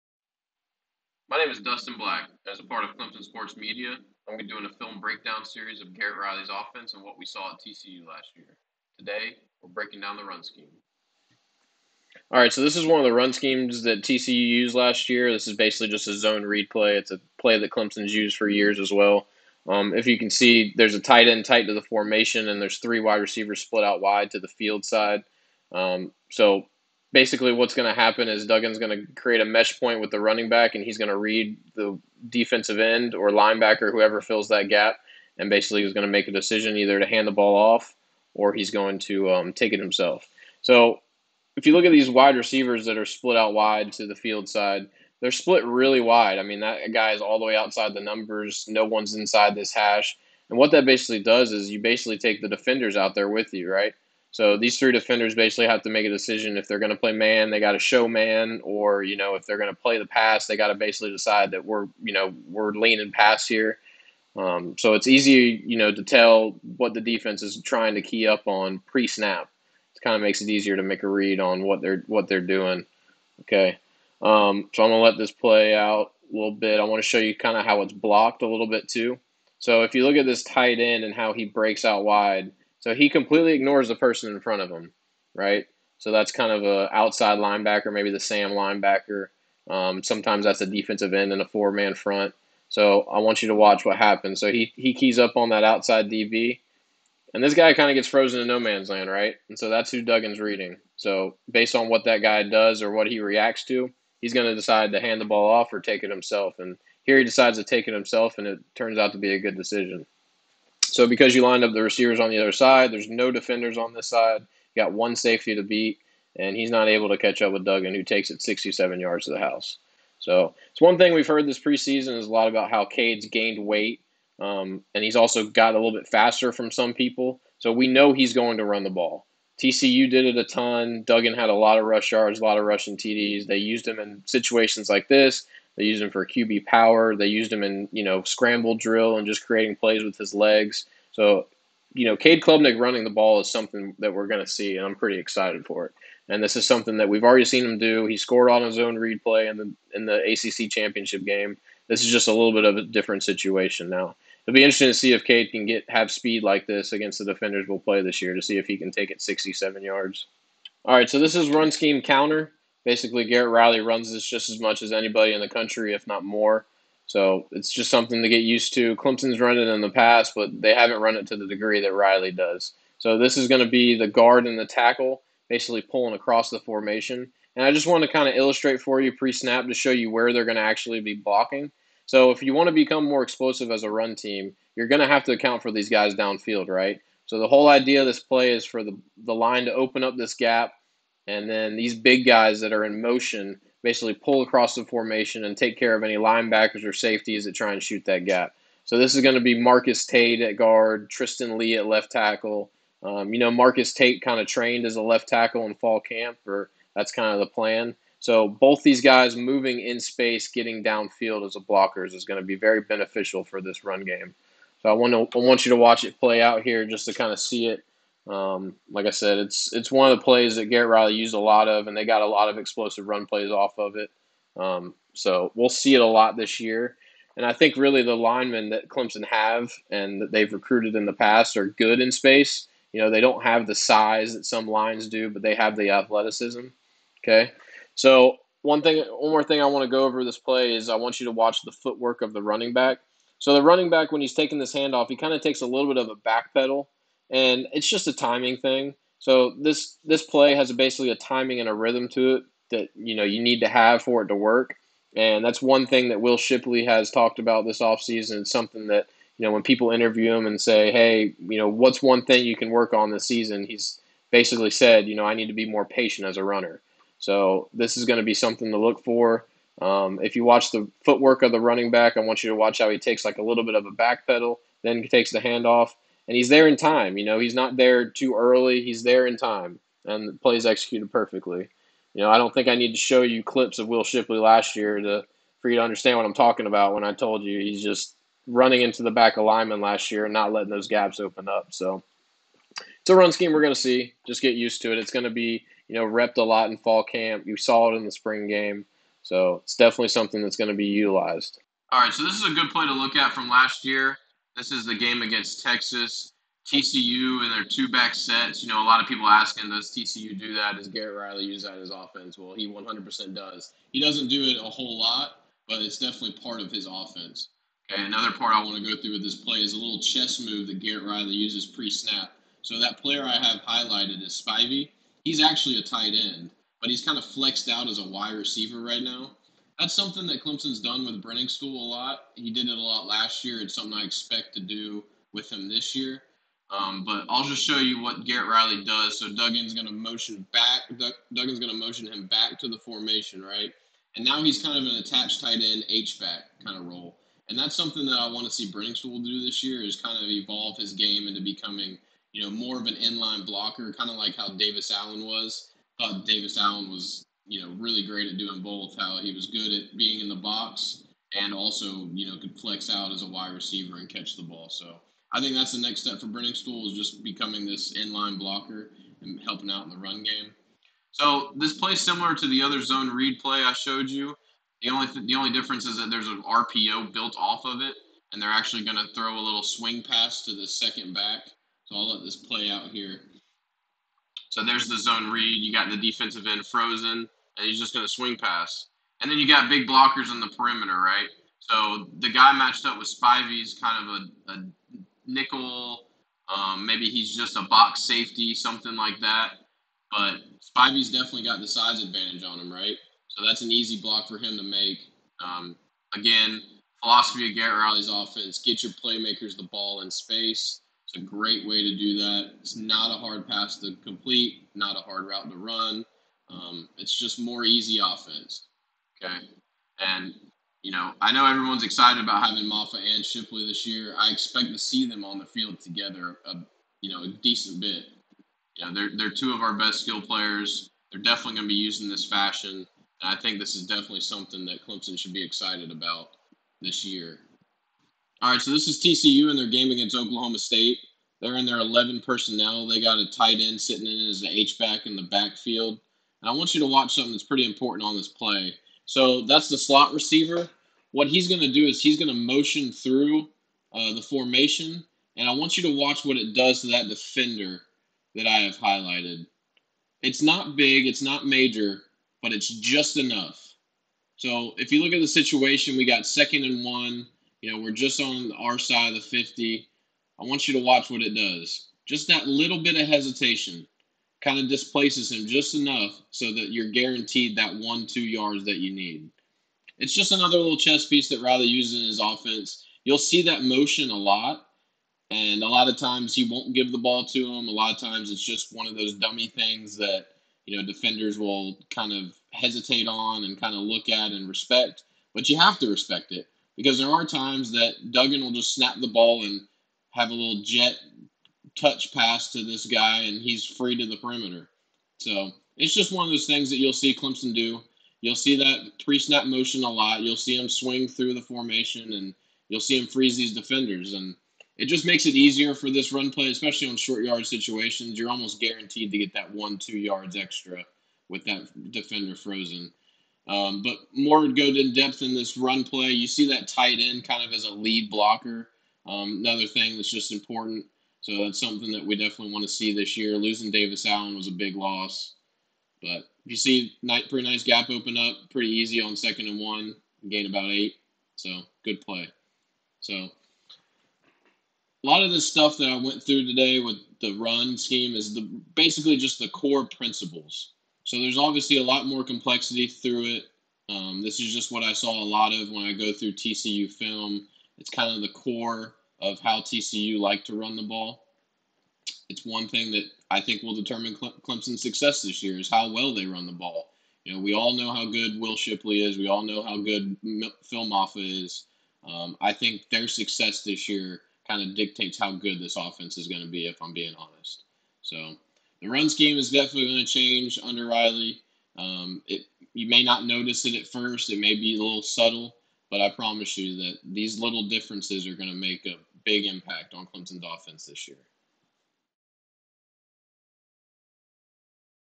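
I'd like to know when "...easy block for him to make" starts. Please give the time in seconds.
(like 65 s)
403 s.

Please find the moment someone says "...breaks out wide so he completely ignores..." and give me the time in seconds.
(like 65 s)
81 s.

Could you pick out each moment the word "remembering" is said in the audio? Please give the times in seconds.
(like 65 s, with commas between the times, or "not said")
not said.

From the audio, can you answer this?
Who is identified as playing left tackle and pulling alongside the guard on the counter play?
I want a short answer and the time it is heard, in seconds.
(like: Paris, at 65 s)
Tristan Leigh, at 201 s.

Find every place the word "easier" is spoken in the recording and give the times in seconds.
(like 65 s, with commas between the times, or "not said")
70 s, 515 s.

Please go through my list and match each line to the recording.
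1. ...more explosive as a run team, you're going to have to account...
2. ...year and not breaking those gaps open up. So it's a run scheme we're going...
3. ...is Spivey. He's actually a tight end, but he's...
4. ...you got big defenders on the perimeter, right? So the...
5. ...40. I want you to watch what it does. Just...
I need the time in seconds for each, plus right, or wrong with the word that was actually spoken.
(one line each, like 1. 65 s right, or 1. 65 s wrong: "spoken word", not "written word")
1. 183 s right
2. 290 s wrong: "letting", not "breaking"
3. 324 s right
4. 389 s wrong: "blockers", not "defenders"
5. 469 s wrong: "50", not "40".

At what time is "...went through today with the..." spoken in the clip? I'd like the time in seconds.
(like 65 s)
546 s.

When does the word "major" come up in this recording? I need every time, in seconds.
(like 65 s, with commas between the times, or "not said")
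461 s.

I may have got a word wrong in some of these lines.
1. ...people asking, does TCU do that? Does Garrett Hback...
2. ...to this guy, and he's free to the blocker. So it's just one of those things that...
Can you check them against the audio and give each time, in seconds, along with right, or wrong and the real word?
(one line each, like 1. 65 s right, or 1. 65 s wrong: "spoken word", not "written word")
1. 309 s wrong: "Riley", not "Hback"
2. 502 s wrong: "perimeter", not "blocker".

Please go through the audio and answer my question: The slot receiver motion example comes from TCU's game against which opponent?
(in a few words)
Oklahoma State.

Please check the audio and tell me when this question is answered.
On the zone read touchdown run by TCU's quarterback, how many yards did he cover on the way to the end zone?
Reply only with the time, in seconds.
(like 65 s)
118 s.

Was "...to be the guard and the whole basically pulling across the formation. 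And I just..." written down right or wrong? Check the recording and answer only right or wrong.
wrong.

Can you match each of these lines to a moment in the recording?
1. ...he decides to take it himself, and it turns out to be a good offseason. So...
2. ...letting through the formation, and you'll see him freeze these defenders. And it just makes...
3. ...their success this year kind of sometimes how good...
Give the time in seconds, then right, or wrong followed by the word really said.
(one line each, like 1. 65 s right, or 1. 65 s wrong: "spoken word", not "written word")
1. 107 s wrong: "decision", not "offseason"
2. 510 s wrong: "swing", not "letting"
3. 572 s wrong: "dictates", not "sometimes".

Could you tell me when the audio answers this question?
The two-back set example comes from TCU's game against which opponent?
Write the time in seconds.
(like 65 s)
305 s.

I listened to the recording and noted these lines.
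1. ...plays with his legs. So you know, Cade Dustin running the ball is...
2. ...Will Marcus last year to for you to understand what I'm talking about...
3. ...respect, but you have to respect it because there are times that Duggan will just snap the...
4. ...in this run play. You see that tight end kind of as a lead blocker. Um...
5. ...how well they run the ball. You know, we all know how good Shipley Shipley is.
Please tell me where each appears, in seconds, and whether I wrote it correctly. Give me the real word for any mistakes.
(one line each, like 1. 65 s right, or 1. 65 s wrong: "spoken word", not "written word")
1. 139 s wrong: "Klubnik", not "Dustin"
2. 283 s wrong: "Shipley", not "Marcus"
3. 494 s right
4. 525 s right
5. 565 s wrong: "Will", not "Shipley".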